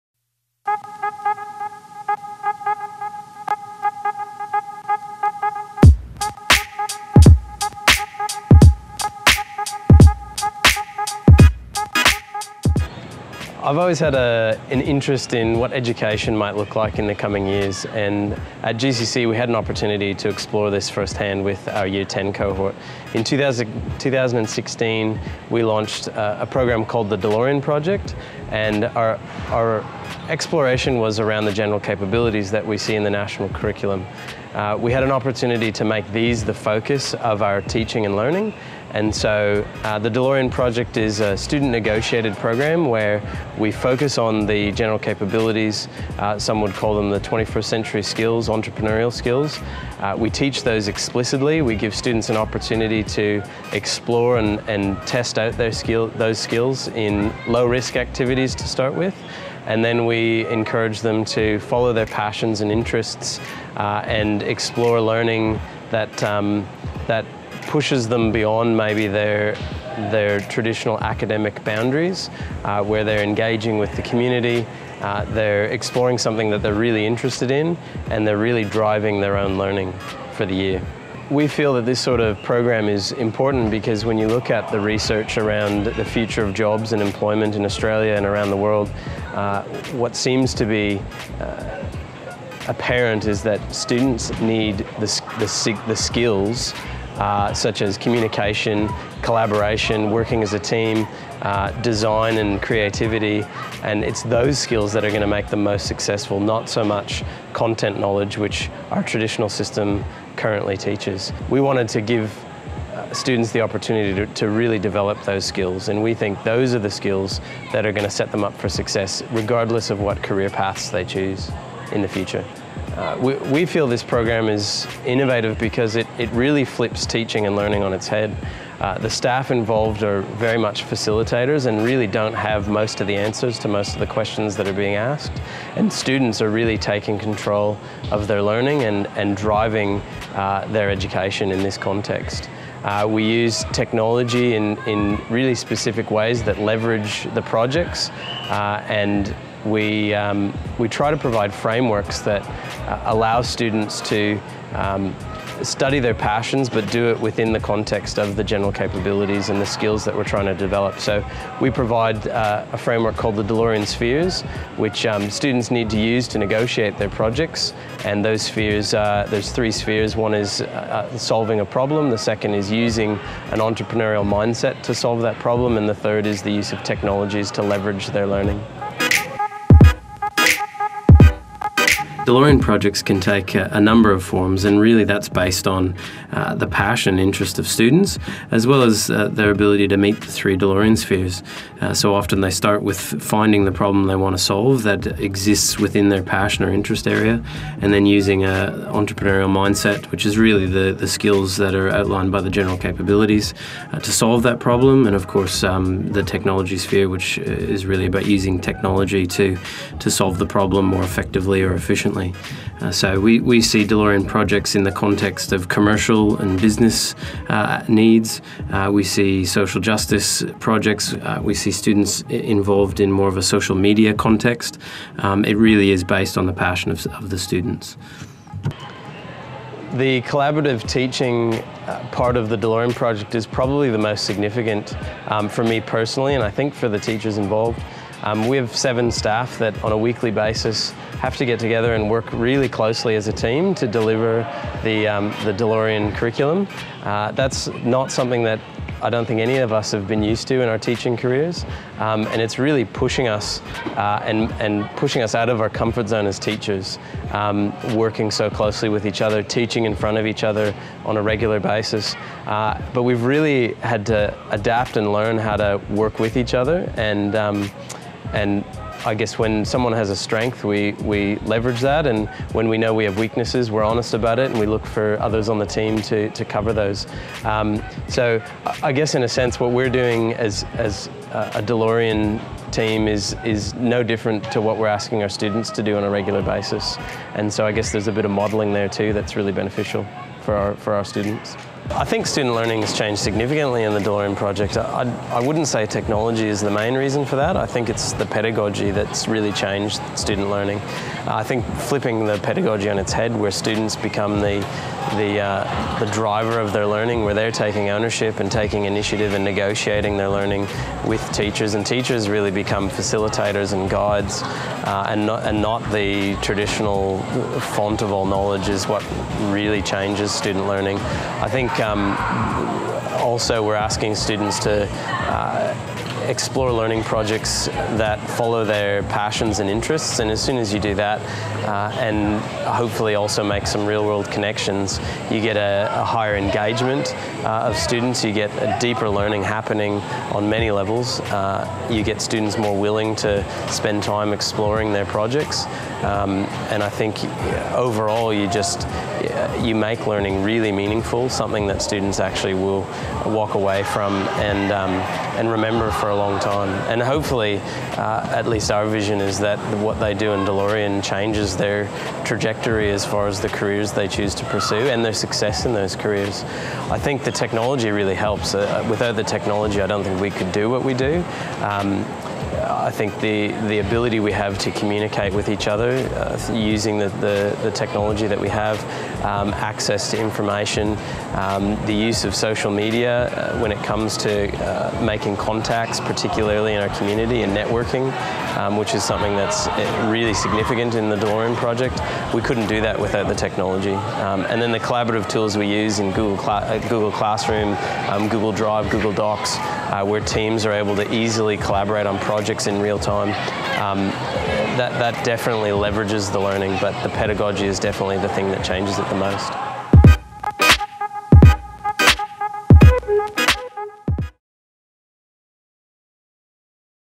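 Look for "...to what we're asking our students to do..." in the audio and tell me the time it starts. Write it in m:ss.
4:44.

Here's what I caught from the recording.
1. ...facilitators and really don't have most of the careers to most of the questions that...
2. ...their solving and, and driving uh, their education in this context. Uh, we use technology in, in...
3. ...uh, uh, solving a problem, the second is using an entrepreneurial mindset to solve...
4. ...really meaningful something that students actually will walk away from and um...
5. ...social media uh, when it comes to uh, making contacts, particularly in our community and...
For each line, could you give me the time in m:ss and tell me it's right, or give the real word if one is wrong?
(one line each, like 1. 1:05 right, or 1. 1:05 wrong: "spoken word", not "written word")
1. 2:10 wrong: "answers", not "careers"
2. 2:18 wrong: "learning", not "solving"
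3. 2:50 right
4. 5:50 right
5. 6:22 right.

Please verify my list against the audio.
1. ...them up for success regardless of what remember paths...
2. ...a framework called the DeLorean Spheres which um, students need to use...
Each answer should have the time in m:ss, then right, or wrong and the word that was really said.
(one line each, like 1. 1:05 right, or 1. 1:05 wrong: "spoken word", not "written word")
1. 1:58 wrong: "career", not "remember"
2. 2:42 right.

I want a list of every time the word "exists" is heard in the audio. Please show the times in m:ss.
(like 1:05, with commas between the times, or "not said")
3:15.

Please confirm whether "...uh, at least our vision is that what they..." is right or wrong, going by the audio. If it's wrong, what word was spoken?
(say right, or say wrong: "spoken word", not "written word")
right.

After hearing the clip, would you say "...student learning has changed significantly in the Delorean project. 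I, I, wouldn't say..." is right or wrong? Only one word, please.
right.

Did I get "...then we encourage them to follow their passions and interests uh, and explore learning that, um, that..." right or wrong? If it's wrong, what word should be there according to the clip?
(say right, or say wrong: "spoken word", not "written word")
right.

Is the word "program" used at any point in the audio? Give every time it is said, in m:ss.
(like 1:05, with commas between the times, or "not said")
0:26, 0:42, 1:22, 2:04.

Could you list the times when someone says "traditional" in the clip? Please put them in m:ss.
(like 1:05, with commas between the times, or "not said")
1:10, 1:49, 5:16.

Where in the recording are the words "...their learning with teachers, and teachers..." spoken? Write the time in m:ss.
5:10.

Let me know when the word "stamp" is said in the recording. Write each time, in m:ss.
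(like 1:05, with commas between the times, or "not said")
not said.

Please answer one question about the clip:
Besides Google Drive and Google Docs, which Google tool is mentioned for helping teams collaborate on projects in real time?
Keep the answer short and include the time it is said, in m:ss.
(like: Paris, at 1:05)
Google Classroom, at 6:36.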